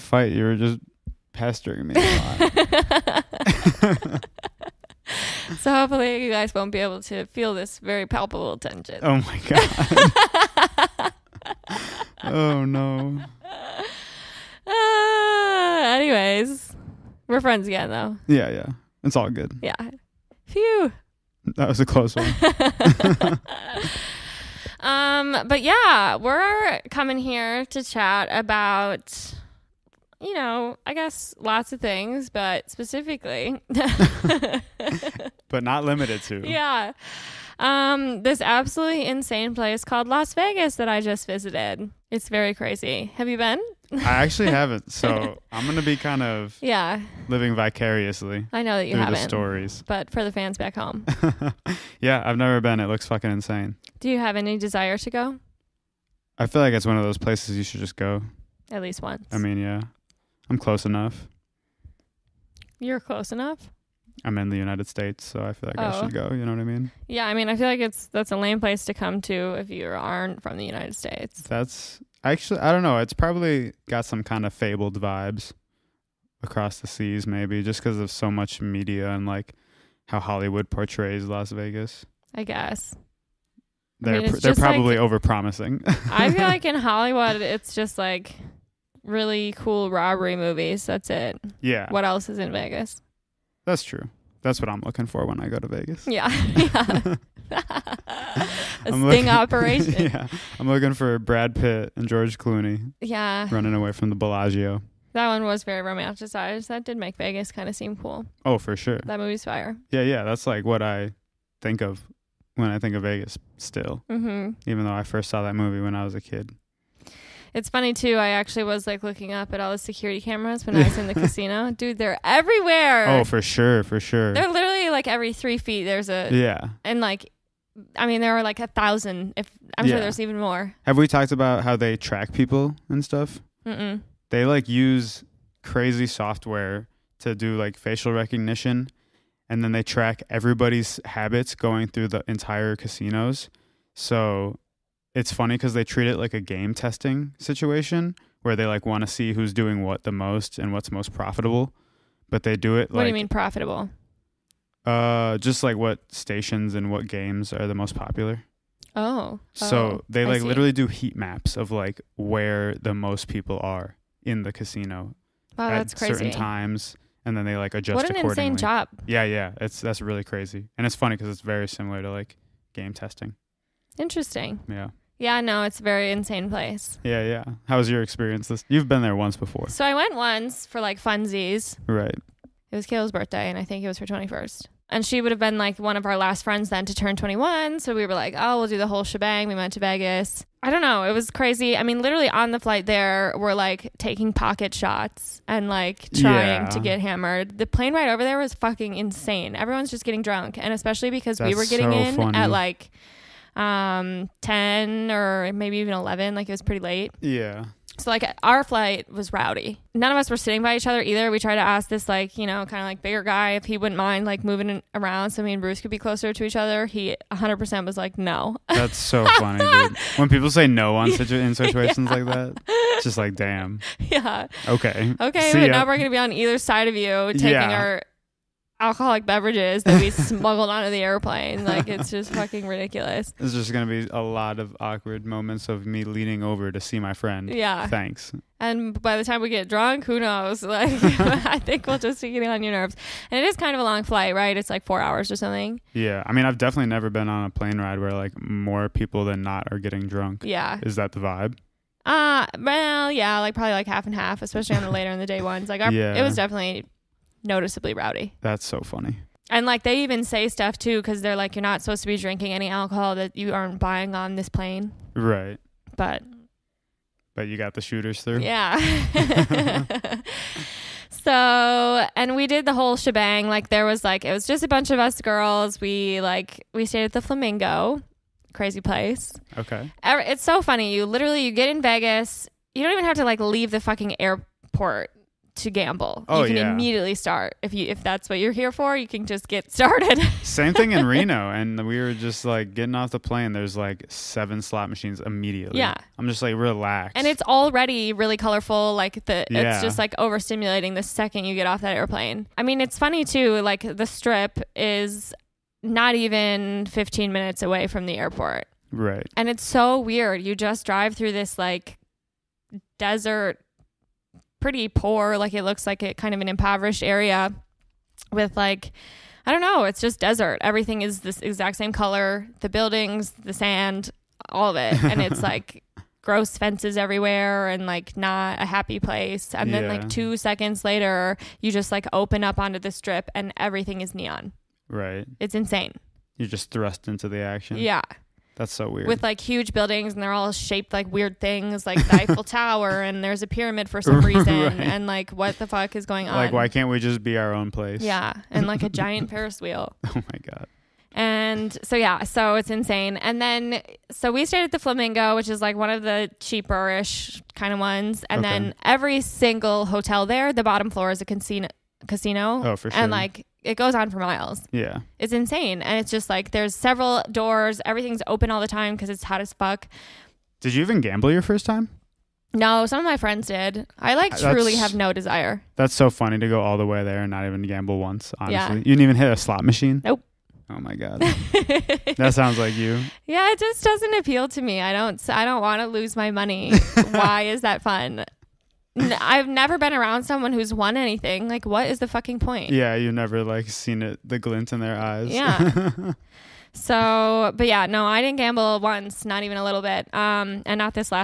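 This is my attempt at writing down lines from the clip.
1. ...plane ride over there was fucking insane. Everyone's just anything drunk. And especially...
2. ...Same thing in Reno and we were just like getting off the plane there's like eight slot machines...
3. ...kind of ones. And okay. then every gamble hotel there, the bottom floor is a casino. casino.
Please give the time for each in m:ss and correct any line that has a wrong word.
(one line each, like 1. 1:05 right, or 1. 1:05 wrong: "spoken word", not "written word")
1. 3:17 wrong: "getting", not "anything"
2. 4:50 wrong: "seven", not "eight"
3. 5:57 wrong: "single", not "gamble".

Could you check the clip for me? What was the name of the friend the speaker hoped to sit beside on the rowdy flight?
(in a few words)
Bruce.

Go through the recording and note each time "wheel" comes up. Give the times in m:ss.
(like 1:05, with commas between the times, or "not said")
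5:49.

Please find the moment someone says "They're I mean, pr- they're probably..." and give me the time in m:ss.
1:24.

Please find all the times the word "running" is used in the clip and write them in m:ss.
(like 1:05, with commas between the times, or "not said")
1:43.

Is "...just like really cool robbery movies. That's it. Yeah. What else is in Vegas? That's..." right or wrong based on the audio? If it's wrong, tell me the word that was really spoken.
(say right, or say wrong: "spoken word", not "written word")
right.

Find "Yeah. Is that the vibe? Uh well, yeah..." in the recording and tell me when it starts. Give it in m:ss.
4:10.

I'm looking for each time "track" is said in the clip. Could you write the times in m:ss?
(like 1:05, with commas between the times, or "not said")
2:11, 2:19.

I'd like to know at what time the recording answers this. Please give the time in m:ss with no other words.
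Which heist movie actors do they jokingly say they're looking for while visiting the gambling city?
1:41.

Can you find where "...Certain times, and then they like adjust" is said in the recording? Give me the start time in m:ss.
2:45.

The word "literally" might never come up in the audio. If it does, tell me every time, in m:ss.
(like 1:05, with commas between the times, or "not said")
2:04, 2:40, 3:12, 4:41.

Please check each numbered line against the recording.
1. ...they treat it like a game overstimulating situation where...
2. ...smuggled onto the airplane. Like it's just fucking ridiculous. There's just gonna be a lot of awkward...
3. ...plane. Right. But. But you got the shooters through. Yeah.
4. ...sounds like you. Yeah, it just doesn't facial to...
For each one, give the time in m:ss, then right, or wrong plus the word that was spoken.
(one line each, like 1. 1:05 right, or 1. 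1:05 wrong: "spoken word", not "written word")
1. 2:25 wrong: "testing", not "overstimulating"
2. 3:50 right
3. 4:24 right
4. 6:22 wrong: "appeal", not "facial".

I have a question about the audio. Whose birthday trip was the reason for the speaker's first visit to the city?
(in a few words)
Kayla.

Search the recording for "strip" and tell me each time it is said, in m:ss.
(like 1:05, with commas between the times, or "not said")
5:04, 5:32.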